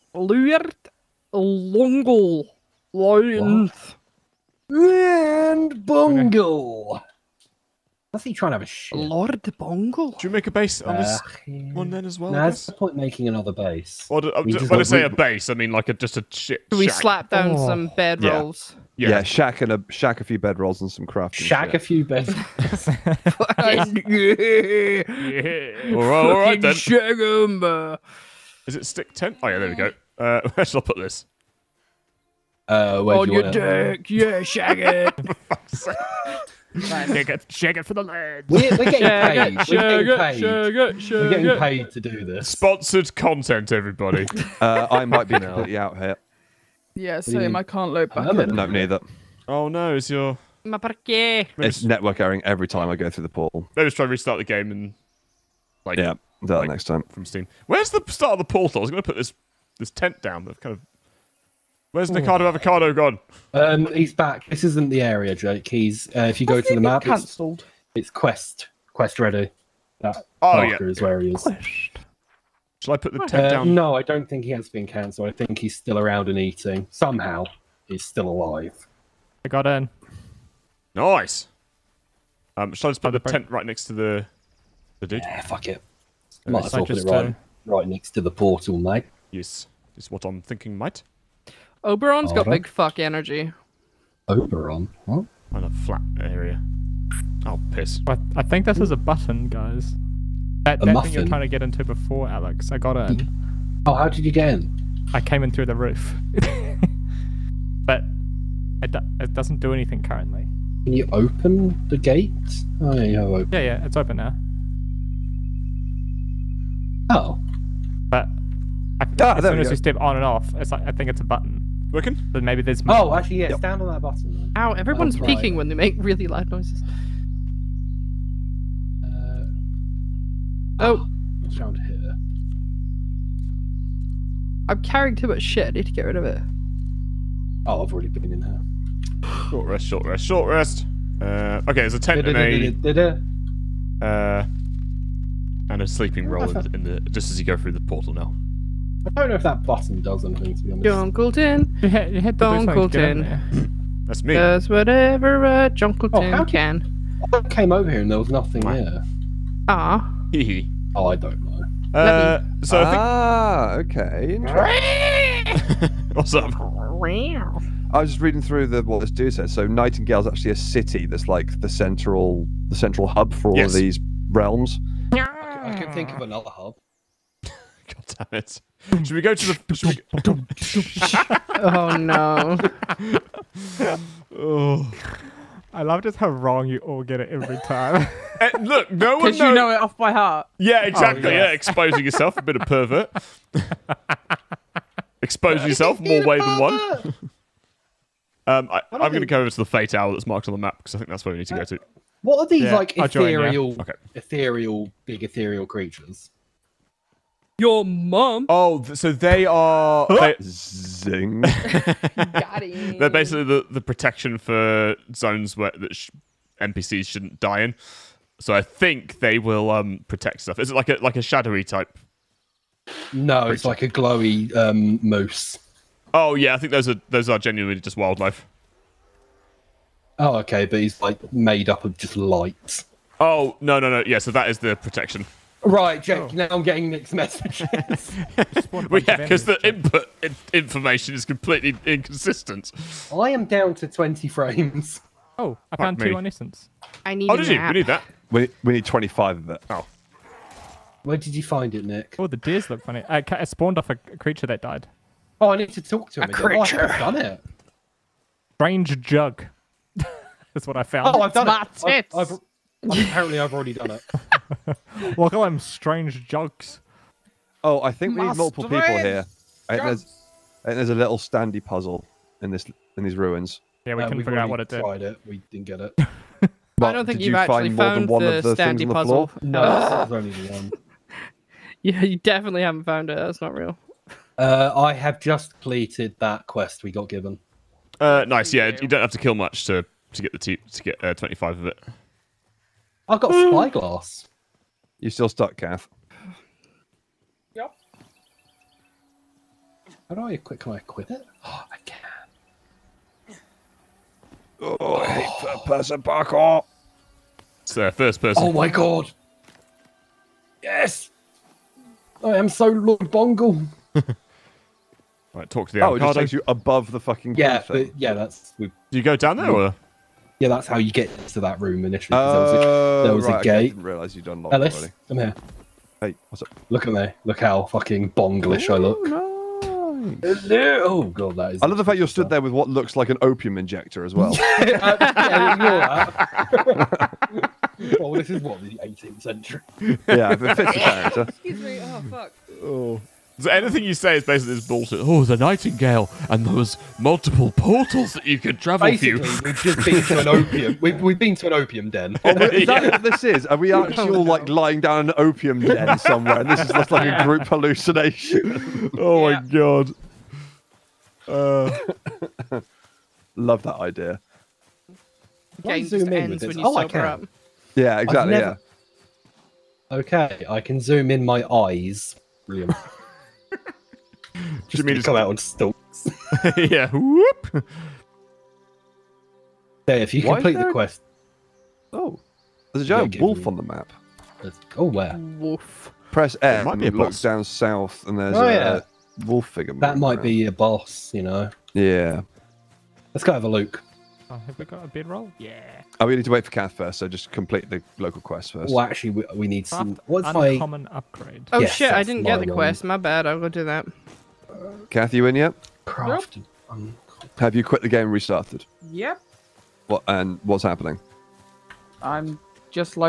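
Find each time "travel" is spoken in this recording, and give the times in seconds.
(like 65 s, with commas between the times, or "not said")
348 s.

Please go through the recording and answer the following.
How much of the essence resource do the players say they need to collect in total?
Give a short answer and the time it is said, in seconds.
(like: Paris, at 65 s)
25, at 248 s.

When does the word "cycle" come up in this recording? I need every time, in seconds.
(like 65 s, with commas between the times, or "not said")
not said.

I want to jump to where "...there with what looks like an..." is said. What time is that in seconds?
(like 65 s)
332 s.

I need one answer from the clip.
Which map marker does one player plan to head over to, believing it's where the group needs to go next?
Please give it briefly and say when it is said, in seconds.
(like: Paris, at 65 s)
Fate Owl, at 199 s.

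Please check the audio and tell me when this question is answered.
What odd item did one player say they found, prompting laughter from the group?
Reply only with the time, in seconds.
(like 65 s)
258 s.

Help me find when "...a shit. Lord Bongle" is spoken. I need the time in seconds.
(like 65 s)
8 s.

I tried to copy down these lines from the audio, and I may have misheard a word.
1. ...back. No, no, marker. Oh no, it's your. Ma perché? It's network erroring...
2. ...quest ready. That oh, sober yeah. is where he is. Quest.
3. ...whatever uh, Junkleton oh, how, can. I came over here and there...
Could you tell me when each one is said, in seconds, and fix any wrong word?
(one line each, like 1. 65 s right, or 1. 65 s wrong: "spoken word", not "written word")
1. 48 s wrong: "neither", not "marker"
2. 68 s wrong: "marker", not "sober"
3. 154 s right.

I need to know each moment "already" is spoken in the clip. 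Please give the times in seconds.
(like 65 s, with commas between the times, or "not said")
137 s, 263 s, 325 s.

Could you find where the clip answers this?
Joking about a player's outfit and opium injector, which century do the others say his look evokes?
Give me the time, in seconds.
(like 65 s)
338 s.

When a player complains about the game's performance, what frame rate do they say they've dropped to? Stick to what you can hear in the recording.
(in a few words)
20 frames.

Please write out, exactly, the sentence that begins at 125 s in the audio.
when they make really loud noises.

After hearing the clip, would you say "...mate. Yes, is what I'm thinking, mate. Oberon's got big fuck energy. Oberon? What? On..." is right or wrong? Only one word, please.
right.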